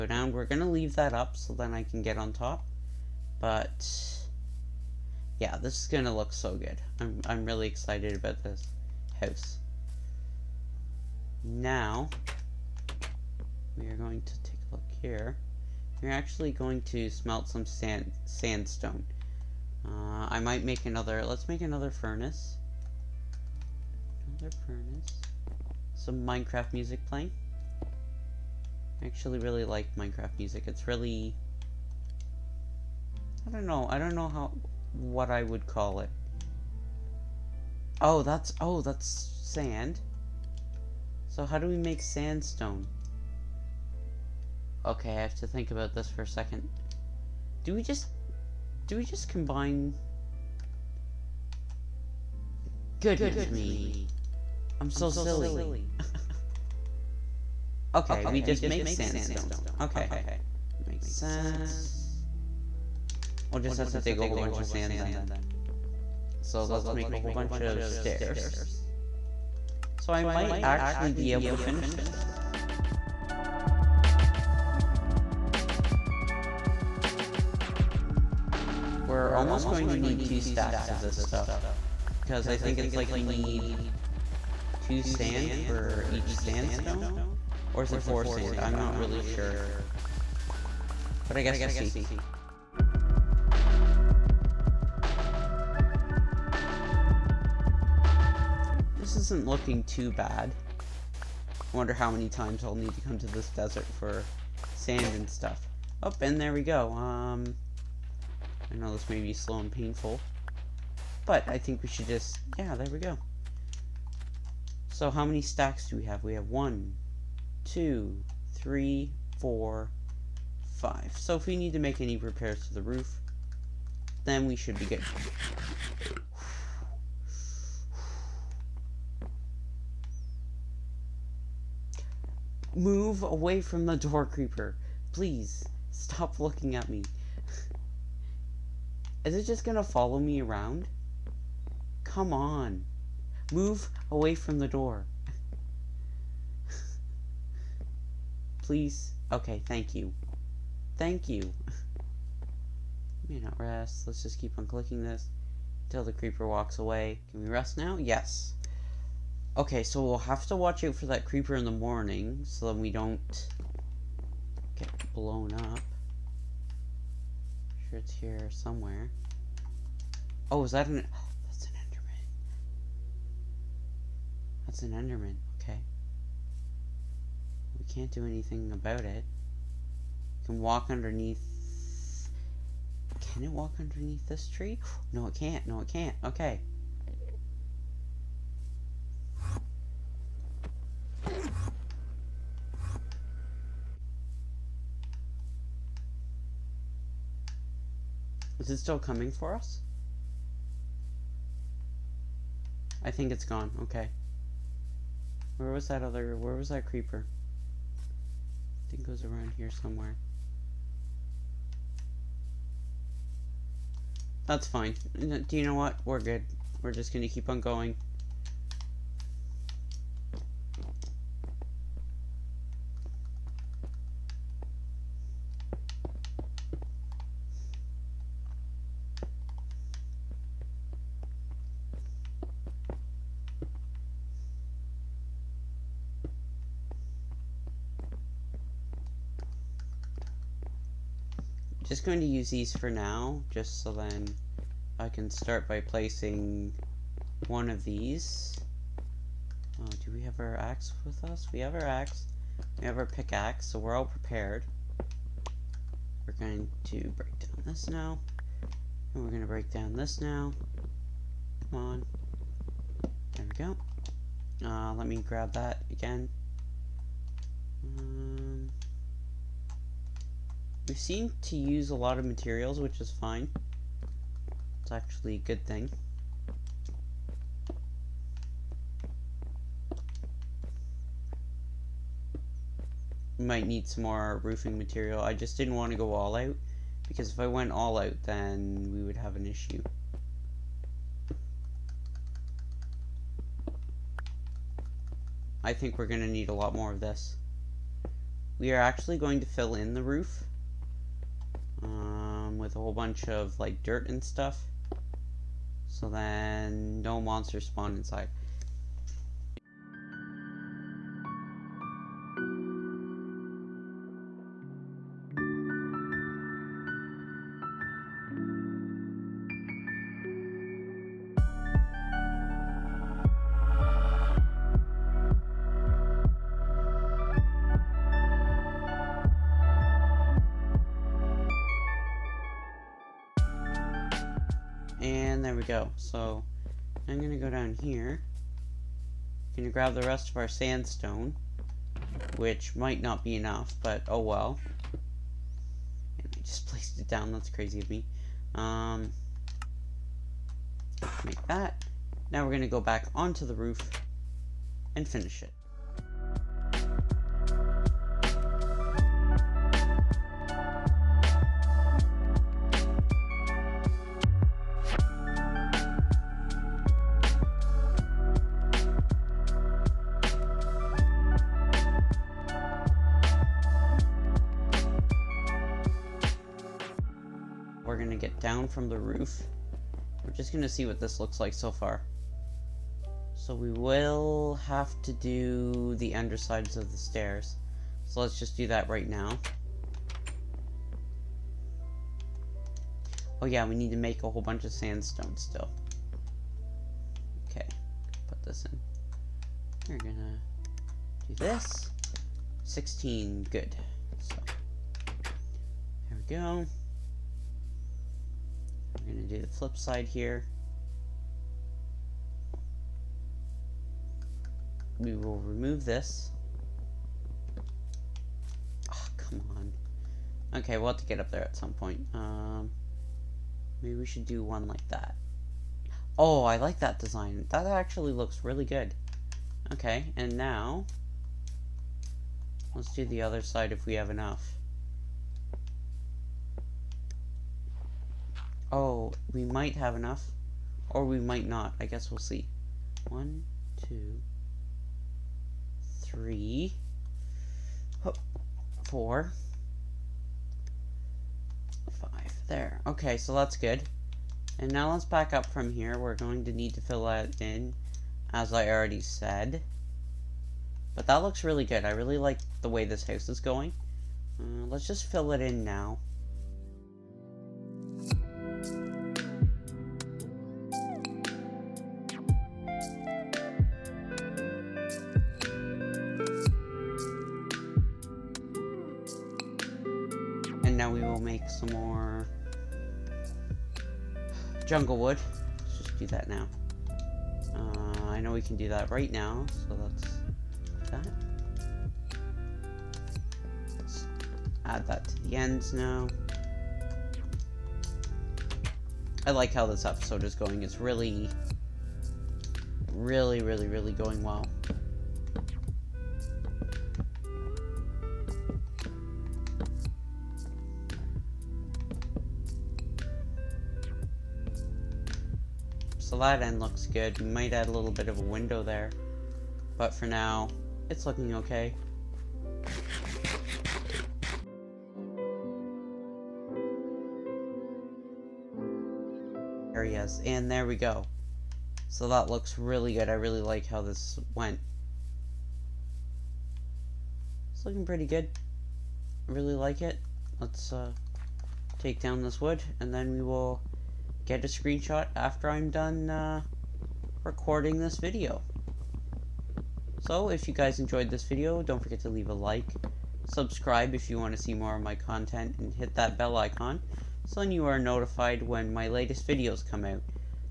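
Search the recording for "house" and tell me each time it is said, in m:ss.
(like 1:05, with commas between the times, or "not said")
0:09, 7:43.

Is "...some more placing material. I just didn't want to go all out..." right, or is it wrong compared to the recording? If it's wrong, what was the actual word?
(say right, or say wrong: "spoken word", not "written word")
wrong: "roofing", not "placing".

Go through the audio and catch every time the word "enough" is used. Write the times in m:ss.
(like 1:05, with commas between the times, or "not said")
5:43, 7:14, 7:19.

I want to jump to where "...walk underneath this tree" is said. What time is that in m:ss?
3:03.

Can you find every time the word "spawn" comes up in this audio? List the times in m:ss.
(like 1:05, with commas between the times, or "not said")
5:07.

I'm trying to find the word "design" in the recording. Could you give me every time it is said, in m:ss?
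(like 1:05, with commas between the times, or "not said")
7:06.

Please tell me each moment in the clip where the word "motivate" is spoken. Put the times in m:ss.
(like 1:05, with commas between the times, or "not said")
not said.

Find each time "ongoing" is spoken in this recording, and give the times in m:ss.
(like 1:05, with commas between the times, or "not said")
not said.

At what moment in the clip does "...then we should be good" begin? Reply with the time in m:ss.
2:04.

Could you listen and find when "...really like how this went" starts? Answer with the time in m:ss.
8:53.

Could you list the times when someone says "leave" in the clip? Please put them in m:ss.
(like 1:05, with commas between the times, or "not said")
0:00, 9:12.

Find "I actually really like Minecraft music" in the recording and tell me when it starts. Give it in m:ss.
0:29.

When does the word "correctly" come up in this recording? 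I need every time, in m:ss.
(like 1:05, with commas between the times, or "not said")
not said.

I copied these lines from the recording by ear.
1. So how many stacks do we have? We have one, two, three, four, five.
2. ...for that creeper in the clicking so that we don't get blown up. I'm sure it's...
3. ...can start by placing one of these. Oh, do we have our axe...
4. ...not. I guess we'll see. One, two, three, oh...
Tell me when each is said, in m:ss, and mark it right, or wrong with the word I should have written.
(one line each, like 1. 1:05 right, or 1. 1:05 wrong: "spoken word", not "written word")
1. 1:54 right
2. 2:40 wrong: "morning", not "clicking"
3. 4:05 right
4. 7:21 right.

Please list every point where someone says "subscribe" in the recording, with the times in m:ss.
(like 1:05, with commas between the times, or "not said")
9:13.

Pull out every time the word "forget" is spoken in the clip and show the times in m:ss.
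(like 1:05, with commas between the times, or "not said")
9:11.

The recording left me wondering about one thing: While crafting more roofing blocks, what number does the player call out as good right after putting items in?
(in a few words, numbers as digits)
16.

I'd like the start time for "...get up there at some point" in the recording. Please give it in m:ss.
7:01.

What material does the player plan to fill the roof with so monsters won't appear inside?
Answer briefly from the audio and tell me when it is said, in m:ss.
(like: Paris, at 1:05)
Dirt, at 5:03.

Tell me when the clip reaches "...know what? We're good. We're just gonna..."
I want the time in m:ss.
3:35.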